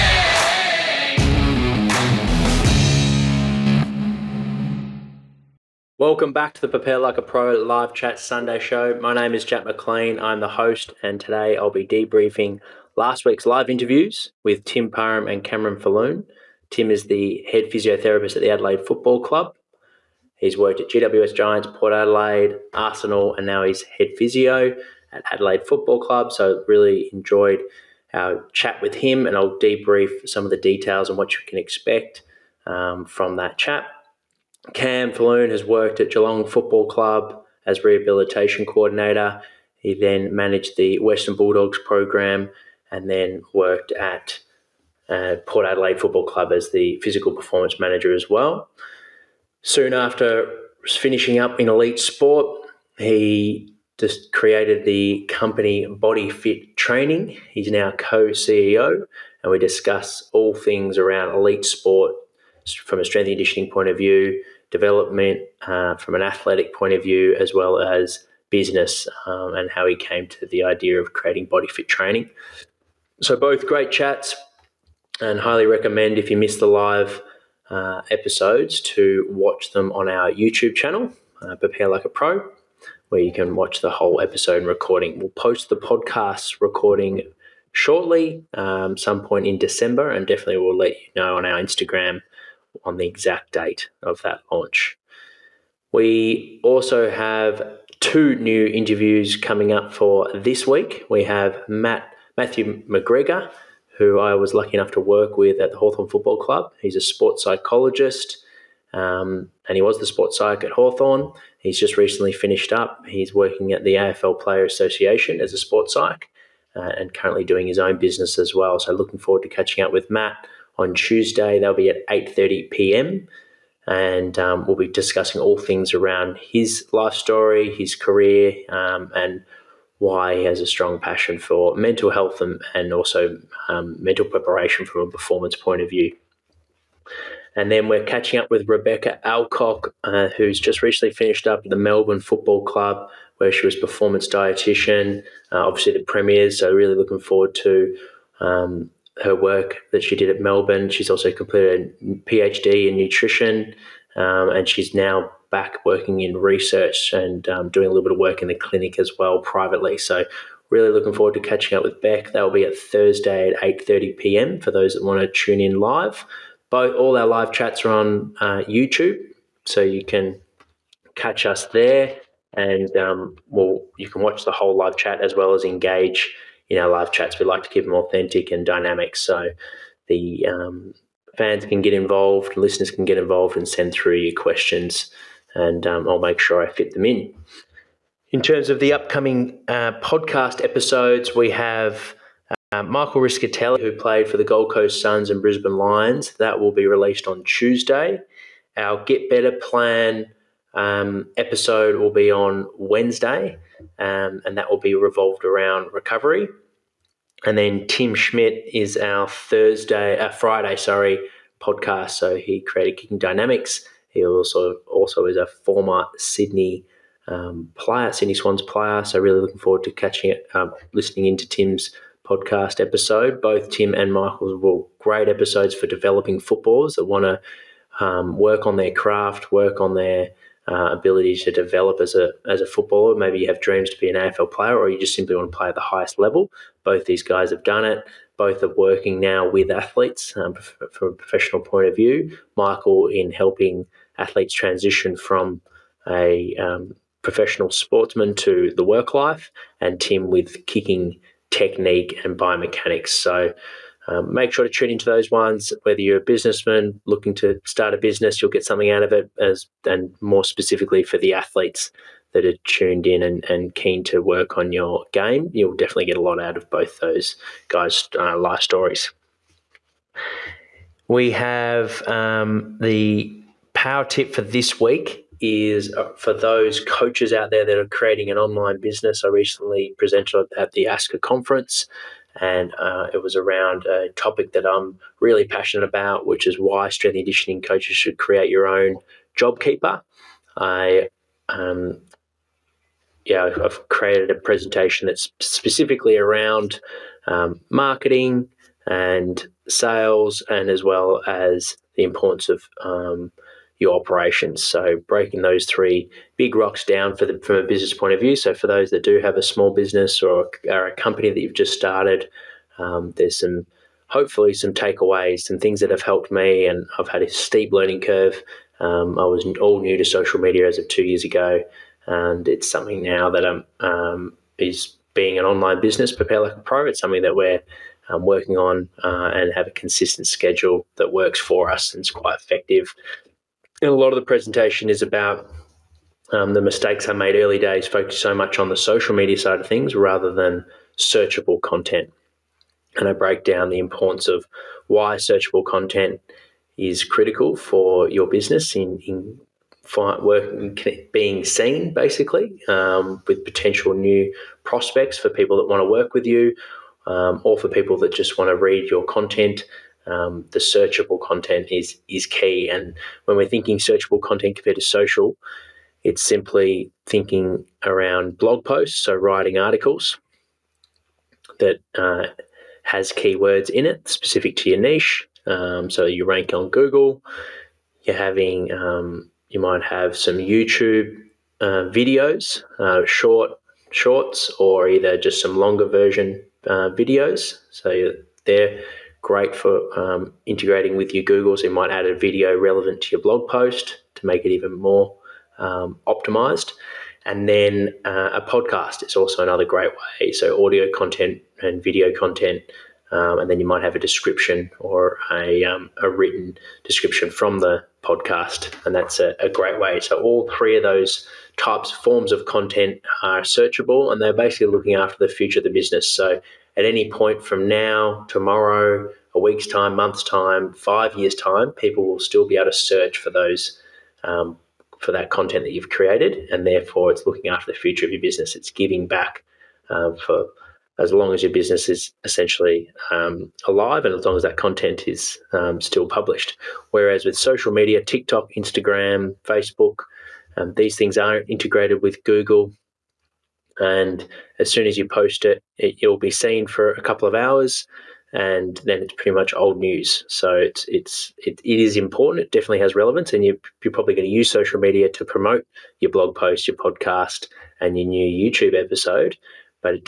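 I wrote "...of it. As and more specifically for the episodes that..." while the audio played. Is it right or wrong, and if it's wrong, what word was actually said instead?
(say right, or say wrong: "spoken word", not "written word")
wrong: "athletes", not "episodes".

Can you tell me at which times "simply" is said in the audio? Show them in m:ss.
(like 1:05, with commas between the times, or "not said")
3:55, 6:06.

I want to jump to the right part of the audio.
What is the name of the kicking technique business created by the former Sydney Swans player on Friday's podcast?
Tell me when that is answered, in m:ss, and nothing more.
3:32.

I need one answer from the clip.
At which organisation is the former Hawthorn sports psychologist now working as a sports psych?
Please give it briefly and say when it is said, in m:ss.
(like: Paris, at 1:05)
AFL Player Association, at 1:53.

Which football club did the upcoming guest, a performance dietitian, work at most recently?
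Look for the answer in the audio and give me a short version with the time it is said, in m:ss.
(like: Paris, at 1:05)
Melbourne Football Club, at 2:21.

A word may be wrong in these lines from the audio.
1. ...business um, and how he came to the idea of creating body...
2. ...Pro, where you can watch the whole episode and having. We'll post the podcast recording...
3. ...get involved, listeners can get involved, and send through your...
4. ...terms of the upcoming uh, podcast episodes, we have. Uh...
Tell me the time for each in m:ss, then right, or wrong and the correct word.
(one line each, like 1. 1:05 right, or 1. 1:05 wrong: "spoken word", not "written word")
1. 1:08 right
2. 1:22 wrong: "recording", not "having"
3. 3:01 right
4. 3:08 right.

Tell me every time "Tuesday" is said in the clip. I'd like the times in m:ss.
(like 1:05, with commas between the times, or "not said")
2:00, 3:17.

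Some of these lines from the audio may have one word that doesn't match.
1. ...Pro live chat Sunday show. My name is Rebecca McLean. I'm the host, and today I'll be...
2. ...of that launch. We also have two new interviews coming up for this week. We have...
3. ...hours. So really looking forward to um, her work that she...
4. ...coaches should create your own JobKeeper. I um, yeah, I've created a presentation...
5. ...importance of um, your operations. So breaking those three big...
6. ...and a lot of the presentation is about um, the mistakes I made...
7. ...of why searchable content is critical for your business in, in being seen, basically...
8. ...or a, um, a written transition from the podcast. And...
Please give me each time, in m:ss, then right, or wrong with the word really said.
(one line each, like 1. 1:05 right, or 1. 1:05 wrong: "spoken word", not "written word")
1. 0:07 wrong: "Jack", not "Rebecca"
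2. 1:34 right
3. 2:25 wrong: "premiers", not "hours"
4. 4:47 right
5. 5:02 right
6. 5:33 right
7. 5:44 right
8. 6:44 wrong: "description", not "transition".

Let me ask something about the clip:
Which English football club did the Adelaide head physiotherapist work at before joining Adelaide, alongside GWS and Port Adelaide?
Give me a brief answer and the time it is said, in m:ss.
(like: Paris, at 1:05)
Arsenal, at 0:22.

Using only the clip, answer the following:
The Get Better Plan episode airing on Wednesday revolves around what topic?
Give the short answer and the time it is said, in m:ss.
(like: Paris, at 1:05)
Recovery, at 3:25.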